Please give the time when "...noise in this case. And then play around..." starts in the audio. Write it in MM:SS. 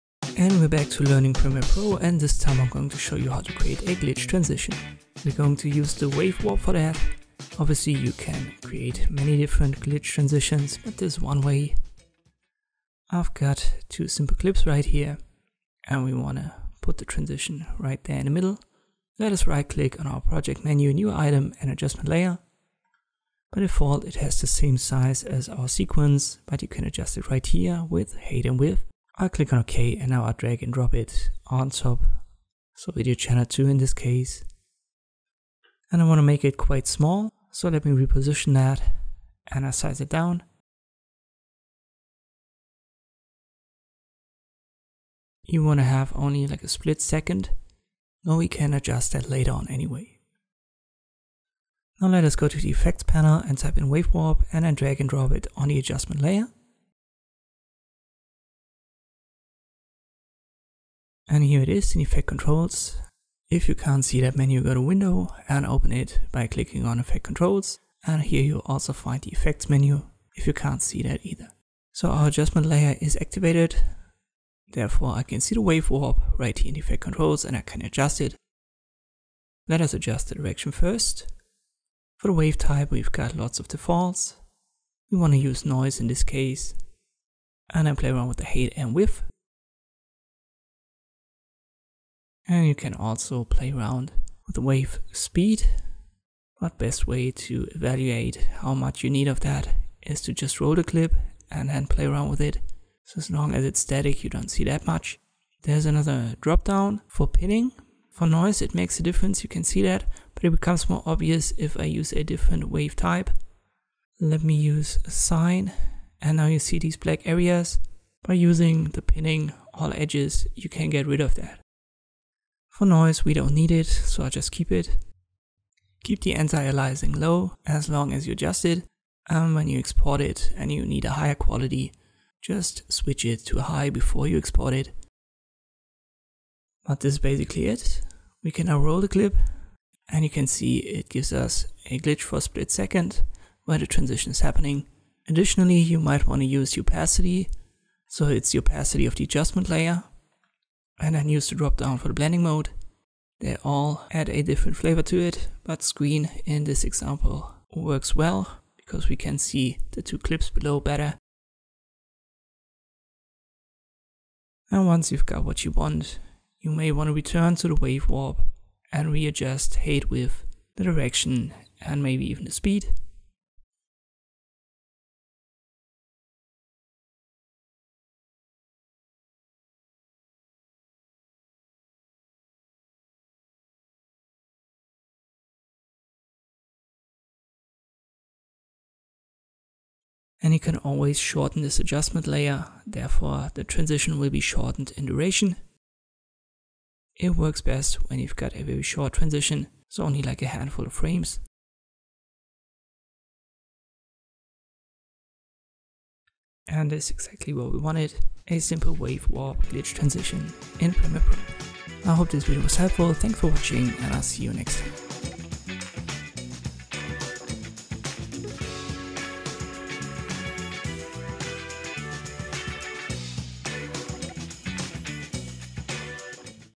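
01:25.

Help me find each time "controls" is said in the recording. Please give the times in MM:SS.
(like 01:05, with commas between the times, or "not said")
01:02, 01:07, 01:17.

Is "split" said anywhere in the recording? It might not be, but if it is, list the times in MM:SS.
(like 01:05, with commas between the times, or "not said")
00:46, 02:22.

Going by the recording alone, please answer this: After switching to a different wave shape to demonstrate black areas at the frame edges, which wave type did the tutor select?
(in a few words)
Sine.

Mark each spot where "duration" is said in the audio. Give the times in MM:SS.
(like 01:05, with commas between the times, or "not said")
03:15.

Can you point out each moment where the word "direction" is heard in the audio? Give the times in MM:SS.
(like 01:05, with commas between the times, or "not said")
01:20, 02:50.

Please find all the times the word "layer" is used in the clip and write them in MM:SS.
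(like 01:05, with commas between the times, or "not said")
00:22, 00:56, 01:12, 02:29, 03:12.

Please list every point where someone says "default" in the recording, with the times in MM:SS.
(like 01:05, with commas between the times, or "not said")
00:23, 01:23.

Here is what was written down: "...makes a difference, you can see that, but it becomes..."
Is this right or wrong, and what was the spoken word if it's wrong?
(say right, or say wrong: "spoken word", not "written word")
right.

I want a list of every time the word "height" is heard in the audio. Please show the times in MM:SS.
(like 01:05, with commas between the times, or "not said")
00:28, 01:28, 02:49.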